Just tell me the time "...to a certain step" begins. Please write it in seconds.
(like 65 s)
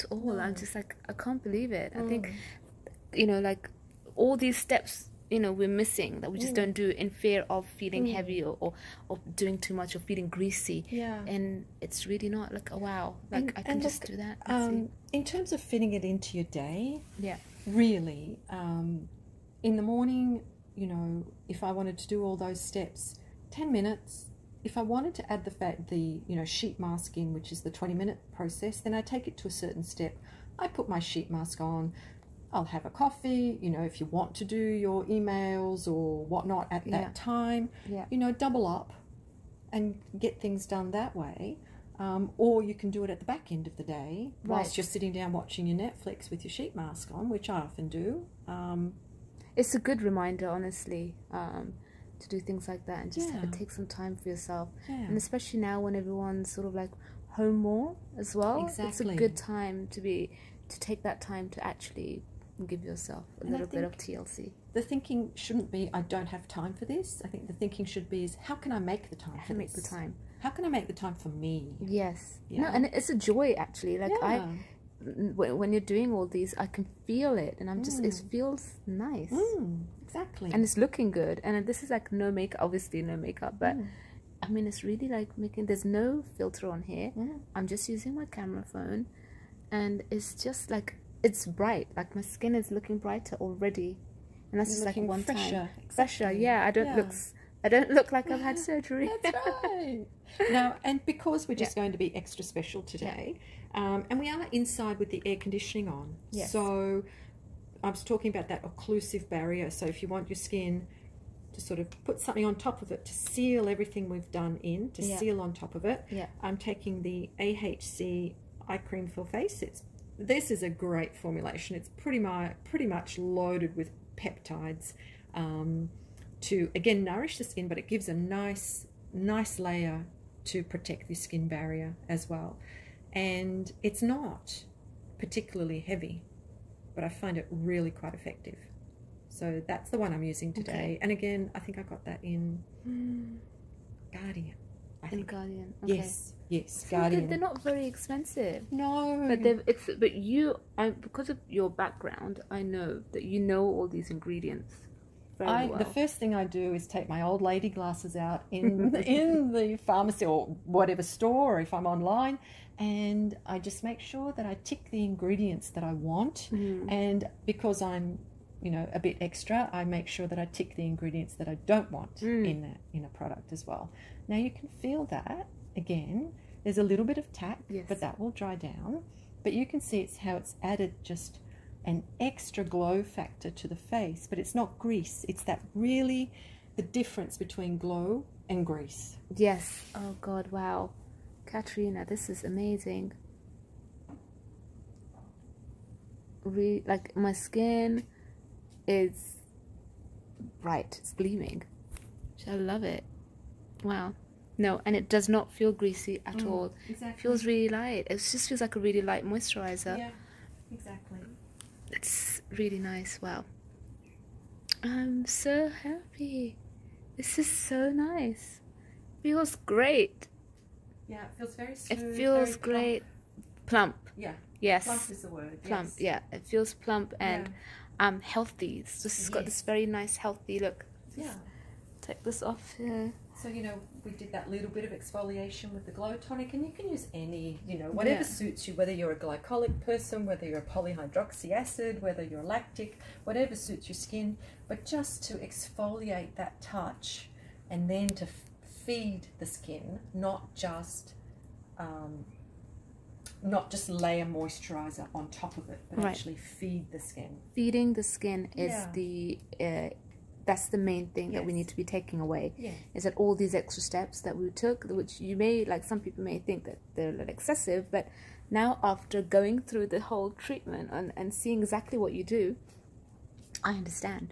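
29 s.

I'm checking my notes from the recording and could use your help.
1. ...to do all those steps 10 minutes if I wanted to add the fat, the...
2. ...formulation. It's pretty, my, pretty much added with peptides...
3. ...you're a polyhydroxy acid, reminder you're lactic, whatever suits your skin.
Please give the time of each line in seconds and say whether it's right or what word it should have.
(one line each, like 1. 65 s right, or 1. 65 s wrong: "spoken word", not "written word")
1. 21 s right
2. 121 s wrong: "loaded", not "added"
3. 240 s wrong: "whether", not "reminder".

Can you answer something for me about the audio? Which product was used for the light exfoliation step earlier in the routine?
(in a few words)
glow tonic.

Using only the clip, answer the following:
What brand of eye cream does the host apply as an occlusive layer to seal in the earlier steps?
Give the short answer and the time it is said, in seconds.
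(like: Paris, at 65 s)
AHC, at 117 s.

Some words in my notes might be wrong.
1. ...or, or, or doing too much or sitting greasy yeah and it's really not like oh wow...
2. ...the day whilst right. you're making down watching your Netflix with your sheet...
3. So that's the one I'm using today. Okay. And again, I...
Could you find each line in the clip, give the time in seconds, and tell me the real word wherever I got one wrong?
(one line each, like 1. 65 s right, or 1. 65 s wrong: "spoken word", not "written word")
1. 8 s wrong: "feeling", not "sitting"
2. 43 s wrong: "sitting", not "making"
3. 139 s right.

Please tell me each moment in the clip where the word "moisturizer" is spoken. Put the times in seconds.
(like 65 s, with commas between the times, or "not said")
209 s, 254 s.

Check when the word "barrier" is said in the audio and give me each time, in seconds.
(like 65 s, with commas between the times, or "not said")
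109 s, 131 s.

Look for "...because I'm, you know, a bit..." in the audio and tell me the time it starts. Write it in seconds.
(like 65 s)
167 s.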